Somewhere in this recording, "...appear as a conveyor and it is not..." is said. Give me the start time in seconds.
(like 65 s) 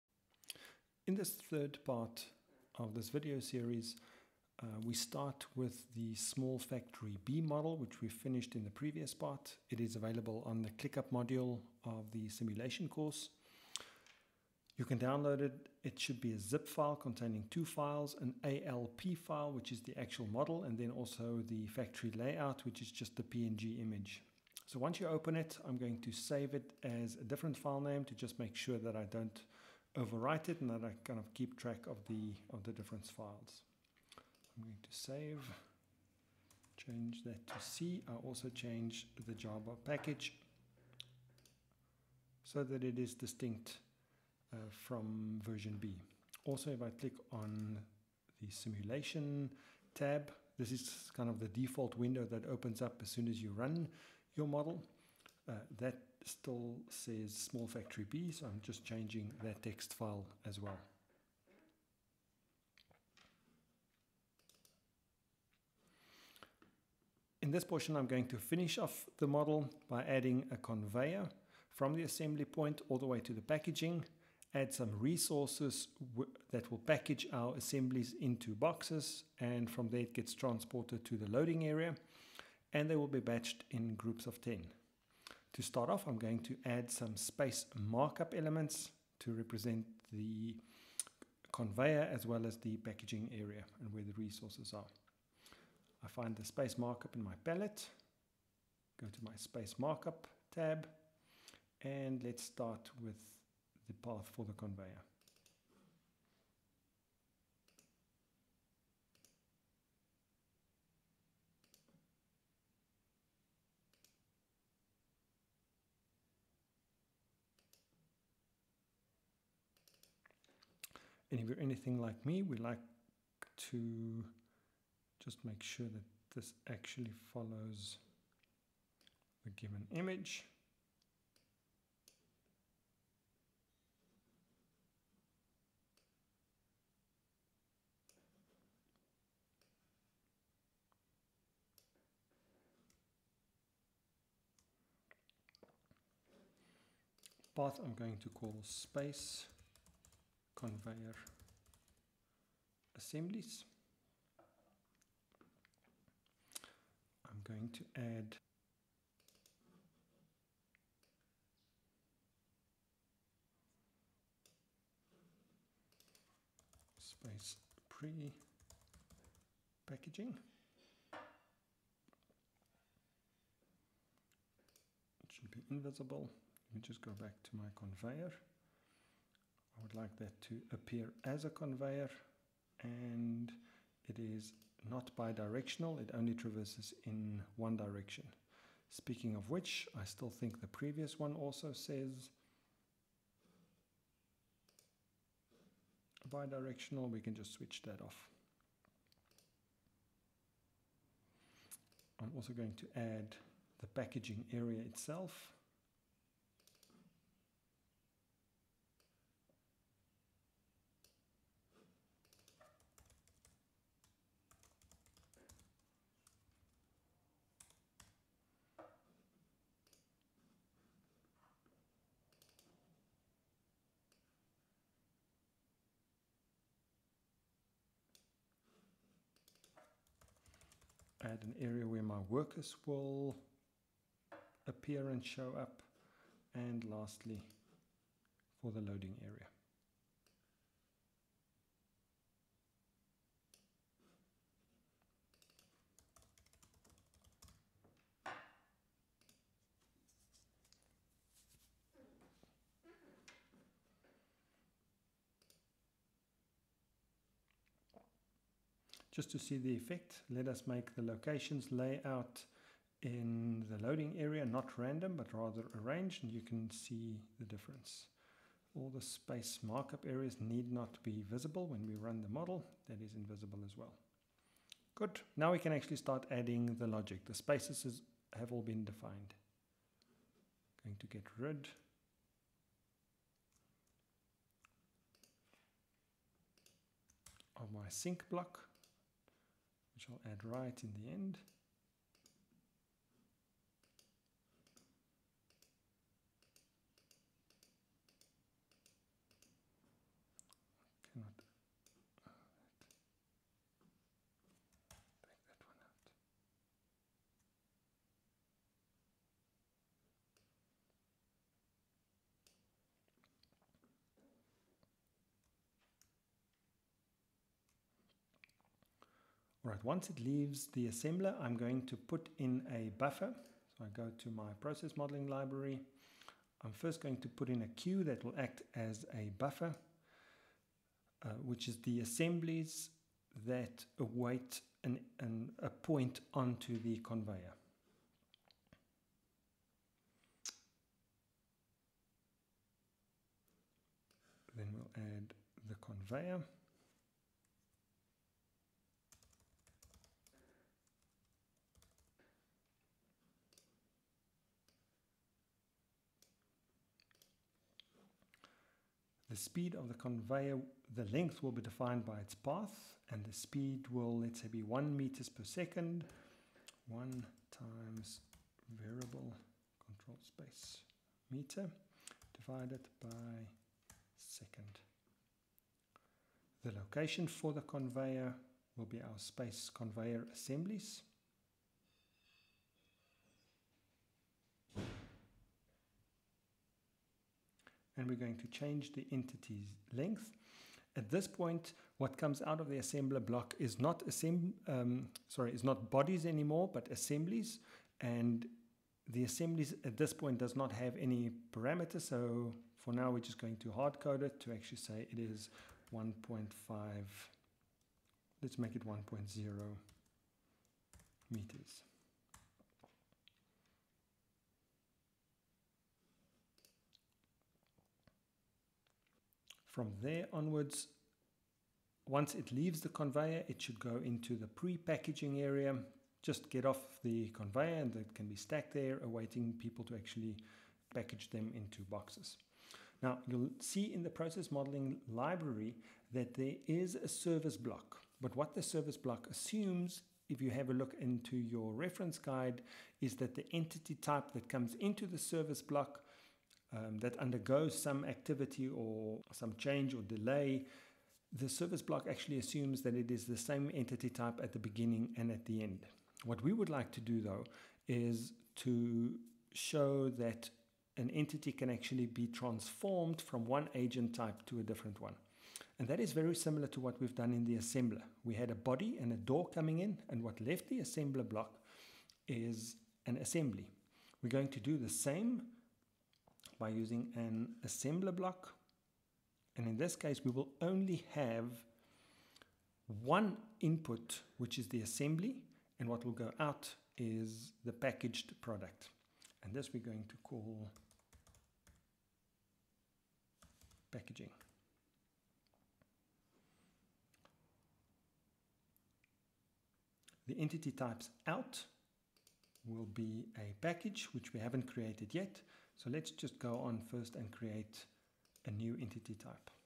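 180 s.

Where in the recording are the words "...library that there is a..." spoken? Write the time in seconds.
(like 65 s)
435 s.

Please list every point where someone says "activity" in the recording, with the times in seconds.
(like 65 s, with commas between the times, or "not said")
448 s.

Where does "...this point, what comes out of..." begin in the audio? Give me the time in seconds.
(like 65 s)
391 s.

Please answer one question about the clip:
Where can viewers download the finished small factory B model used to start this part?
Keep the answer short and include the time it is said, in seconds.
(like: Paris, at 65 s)
ClickUp module, at 10 s.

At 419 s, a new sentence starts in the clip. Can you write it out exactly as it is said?
From there onwards, once it leaves the conveyor, it should go into the pre-packaging area.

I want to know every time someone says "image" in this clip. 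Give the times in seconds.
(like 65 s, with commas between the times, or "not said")
23 s, 129 s.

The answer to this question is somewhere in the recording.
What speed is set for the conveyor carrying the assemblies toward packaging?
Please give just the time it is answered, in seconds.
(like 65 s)
364 s.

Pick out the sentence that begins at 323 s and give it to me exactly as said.
So I go to my process modeling library.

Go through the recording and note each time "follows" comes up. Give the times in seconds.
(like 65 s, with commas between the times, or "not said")
127 s.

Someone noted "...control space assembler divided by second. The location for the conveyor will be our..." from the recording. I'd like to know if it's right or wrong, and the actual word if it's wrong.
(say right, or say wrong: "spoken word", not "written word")
wrong: "meter", not "assembler".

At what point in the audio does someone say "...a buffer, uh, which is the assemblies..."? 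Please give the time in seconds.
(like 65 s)
329 s.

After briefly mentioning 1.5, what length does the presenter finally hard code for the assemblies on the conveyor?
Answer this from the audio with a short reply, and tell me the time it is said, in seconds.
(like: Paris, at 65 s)
1.0 meters, at 408 s.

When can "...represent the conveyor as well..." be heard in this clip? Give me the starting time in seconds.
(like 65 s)
89 s.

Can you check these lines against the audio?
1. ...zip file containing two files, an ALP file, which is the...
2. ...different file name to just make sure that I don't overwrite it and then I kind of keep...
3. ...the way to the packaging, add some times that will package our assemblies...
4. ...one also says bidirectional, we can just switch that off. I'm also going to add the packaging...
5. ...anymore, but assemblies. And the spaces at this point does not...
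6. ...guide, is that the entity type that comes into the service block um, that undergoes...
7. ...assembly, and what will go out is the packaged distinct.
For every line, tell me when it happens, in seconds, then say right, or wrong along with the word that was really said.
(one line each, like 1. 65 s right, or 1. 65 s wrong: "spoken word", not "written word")
1. 16 s right
2. 27 s right
3. 72 s wrong: "resources", not "times"
4. 191 s right
5. 396 s wrong: "assemblies", not "spaces"
6. 442 s right
7. 484 s wrong: "product", not "distinct".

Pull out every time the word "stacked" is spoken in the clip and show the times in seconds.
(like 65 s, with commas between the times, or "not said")
428 s.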